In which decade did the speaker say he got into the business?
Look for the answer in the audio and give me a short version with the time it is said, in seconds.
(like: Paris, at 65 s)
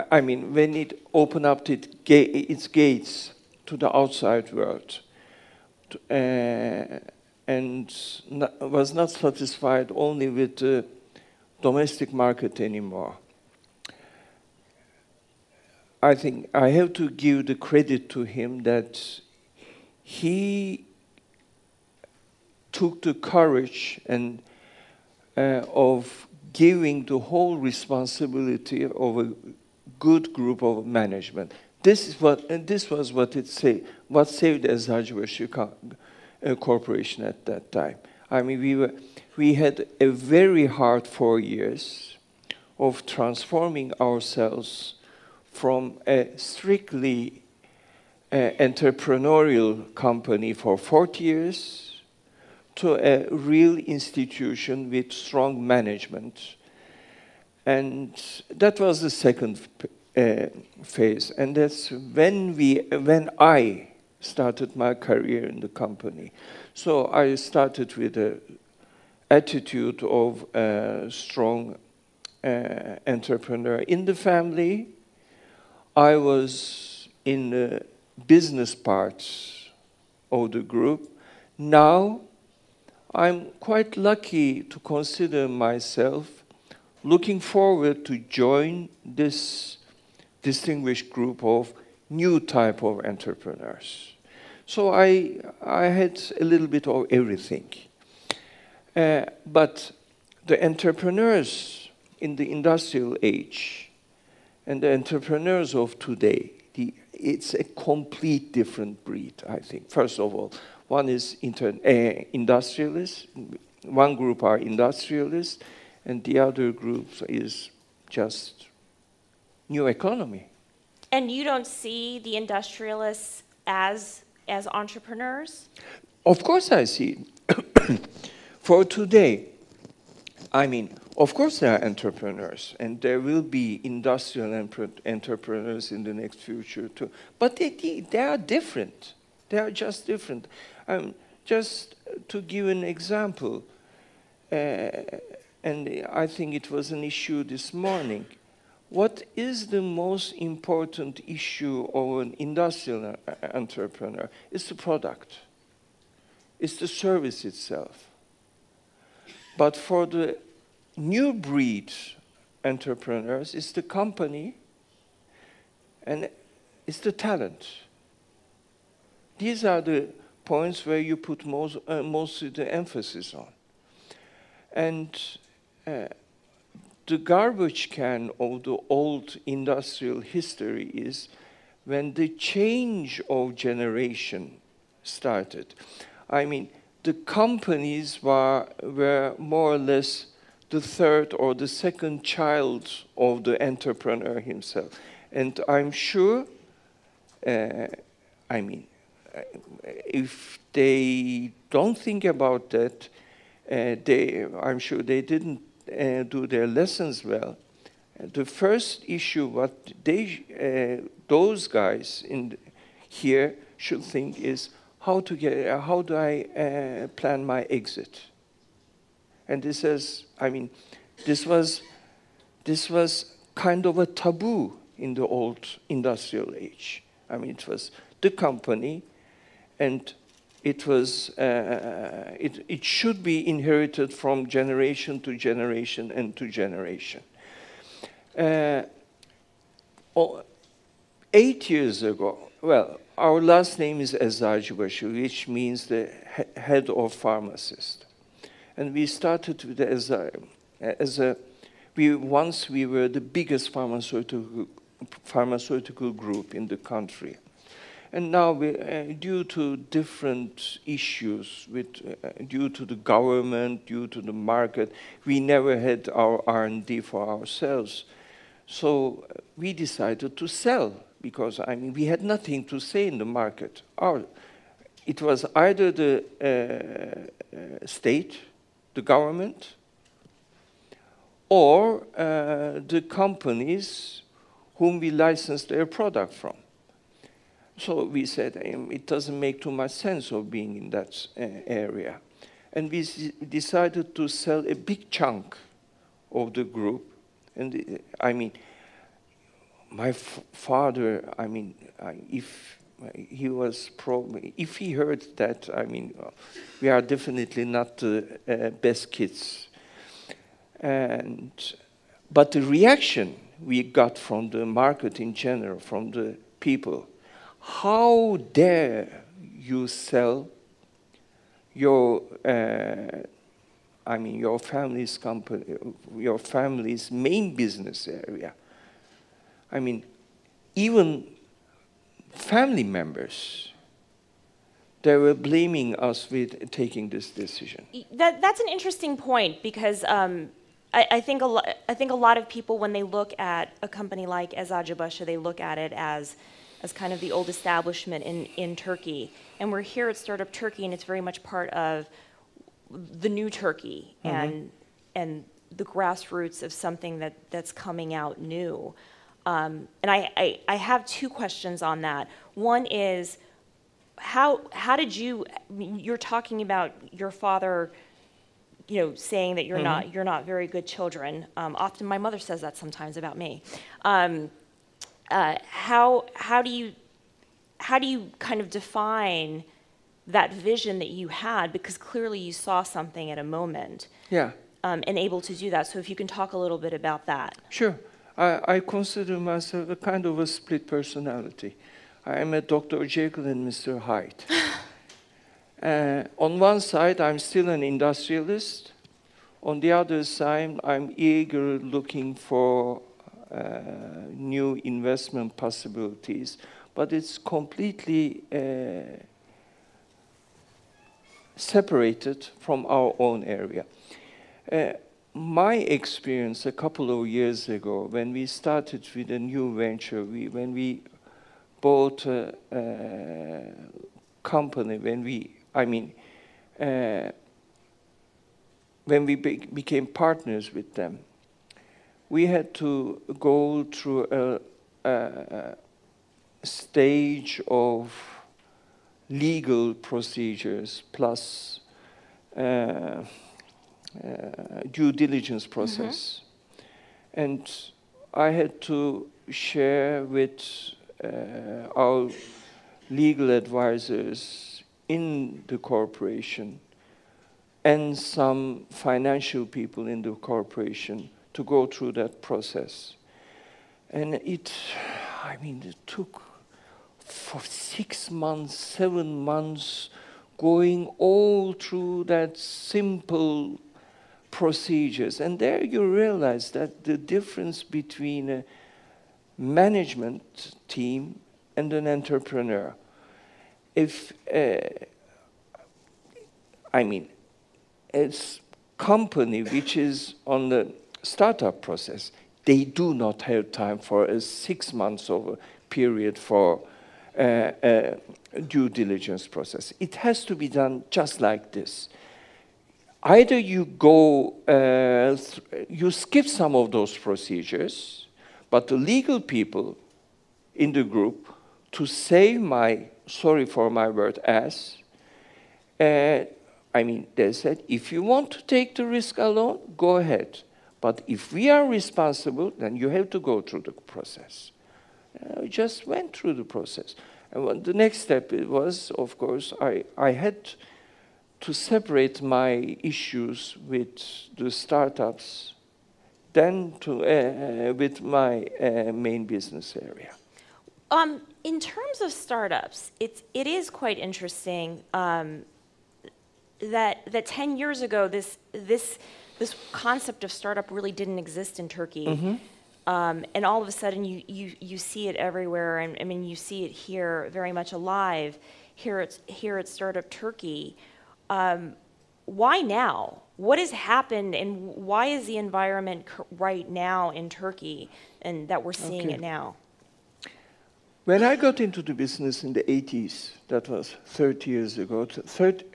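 1980s, at 572 s.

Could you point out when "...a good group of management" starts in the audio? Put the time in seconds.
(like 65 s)
29 s.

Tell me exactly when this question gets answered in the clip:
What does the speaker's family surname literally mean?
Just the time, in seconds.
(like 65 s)
245 s.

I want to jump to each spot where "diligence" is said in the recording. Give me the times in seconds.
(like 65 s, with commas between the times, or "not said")
445 s, 498 s.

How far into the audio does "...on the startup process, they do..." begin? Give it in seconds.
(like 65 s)
490 s.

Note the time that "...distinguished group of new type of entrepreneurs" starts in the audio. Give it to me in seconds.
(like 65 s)
90 s.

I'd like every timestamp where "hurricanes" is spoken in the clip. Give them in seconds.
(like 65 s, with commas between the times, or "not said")
not said.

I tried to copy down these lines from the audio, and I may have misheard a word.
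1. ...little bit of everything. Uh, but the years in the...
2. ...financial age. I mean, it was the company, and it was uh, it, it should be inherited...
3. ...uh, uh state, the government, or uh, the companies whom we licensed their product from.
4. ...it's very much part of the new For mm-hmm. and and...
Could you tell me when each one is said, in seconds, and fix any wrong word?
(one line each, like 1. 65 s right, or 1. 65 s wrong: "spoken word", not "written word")
1. 96 s wrong: "entrepreneurs", not "years"
2. 225 s wrong: "industrial", not "financial"
3. 276 s right
4. 350 s wrong: "Turkey", not "For".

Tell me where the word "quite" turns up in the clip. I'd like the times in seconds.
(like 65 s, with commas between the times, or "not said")
83 s, 543 s.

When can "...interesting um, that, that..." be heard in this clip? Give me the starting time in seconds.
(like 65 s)
544 s.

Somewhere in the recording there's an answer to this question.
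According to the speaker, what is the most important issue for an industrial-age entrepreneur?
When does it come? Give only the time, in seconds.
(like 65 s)
154 s.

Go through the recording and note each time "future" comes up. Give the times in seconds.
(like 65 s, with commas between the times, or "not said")
136 s.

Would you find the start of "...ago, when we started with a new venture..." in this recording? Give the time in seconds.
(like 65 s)
417 s.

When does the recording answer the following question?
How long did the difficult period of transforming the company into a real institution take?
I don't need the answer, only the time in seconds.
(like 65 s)
41 s.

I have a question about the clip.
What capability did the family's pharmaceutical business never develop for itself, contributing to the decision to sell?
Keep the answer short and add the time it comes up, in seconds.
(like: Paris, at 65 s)
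R&D, at 266 s.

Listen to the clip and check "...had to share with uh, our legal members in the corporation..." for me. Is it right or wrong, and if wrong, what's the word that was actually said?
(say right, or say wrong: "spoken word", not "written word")
wrong: "advisors", not "members".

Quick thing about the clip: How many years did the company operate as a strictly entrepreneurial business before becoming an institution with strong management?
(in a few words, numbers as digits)
40.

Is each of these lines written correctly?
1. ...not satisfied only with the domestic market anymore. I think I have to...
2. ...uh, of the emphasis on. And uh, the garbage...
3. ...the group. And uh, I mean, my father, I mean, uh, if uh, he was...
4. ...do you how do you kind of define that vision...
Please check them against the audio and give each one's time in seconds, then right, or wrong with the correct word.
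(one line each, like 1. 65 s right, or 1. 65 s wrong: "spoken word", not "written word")
1. 8 s right
2. 171 s right
3. 296 s right
4. 376 s right.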